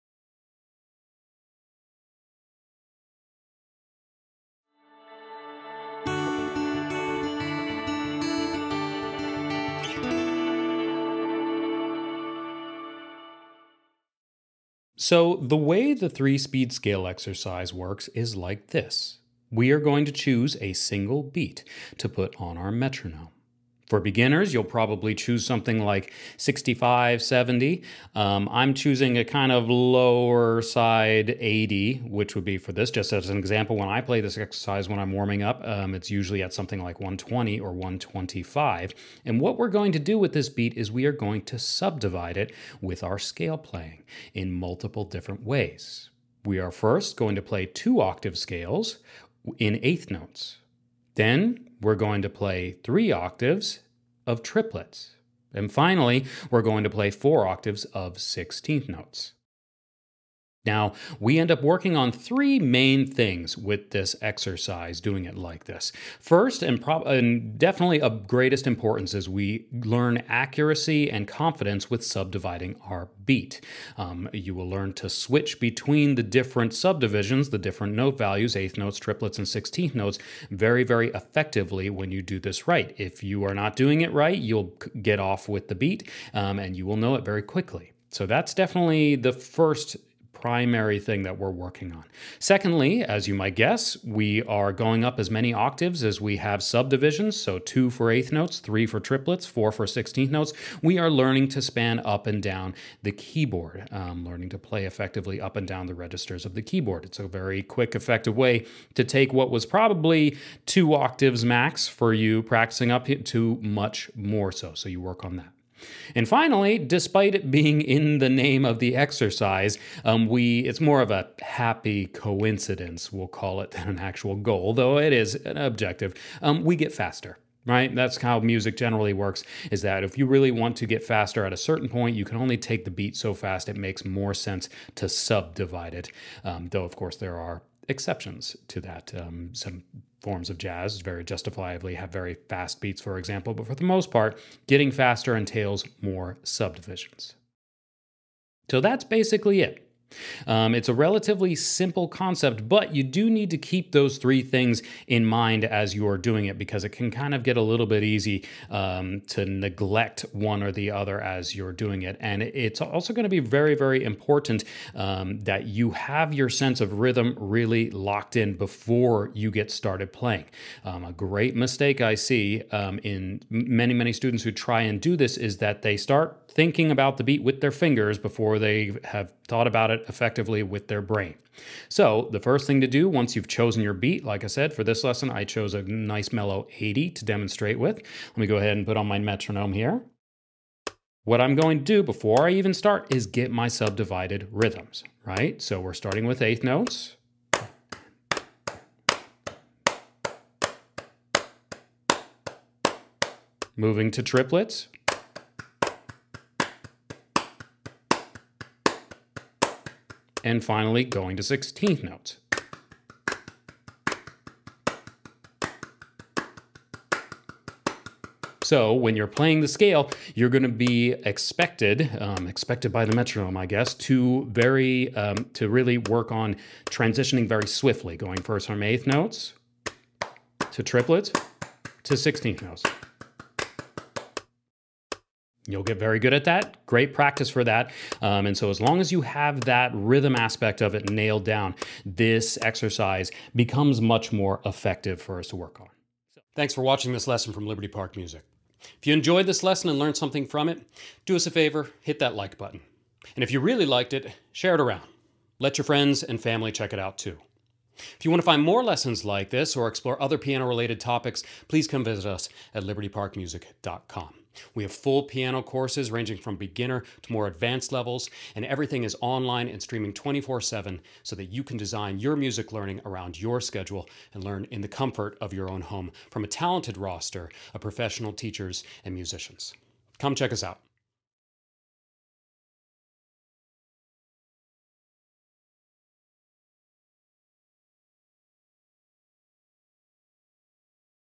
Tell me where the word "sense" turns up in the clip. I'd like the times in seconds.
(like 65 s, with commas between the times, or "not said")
134 s, 166 s.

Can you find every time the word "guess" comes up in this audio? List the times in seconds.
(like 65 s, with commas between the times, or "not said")
93 s, 223 s.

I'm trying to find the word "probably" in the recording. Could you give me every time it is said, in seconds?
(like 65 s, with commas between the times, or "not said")
24 s, 109 s.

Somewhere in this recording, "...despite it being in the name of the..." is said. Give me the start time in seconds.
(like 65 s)
116 s.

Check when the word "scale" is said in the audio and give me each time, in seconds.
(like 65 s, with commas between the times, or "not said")
16 s, 43 s, 48 s, 219 s.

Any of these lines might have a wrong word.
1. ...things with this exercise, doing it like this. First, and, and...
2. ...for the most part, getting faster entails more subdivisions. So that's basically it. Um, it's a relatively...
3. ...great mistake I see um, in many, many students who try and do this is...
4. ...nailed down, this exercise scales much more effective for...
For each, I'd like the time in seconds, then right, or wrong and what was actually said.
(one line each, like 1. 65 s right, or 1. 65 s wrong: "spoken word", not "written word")
1. 63 s right
2. 143 s right
3. 171 s right
4. 241 s wrong: "becomes", not "scales".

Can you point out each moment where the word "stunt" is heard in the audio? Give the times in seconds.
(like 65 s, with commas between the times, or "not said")
not said.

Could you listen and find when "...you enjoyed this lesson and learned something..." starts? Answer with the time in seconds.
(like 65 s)
249 s.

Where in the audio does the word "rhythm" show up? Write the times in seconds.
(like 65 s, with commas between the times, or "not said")
166 s, 194 s, 239 s.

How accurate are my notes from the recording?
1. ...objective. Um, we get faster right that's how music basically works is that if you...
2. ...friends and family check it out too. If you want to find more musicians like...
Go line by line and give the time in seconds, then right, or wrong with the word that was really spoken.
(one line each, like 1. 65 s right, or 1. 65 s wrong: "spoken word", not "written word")
1. 125 s wrong: "generally", not "basically"
2. 255 s wrong: "lessons", not "musicians".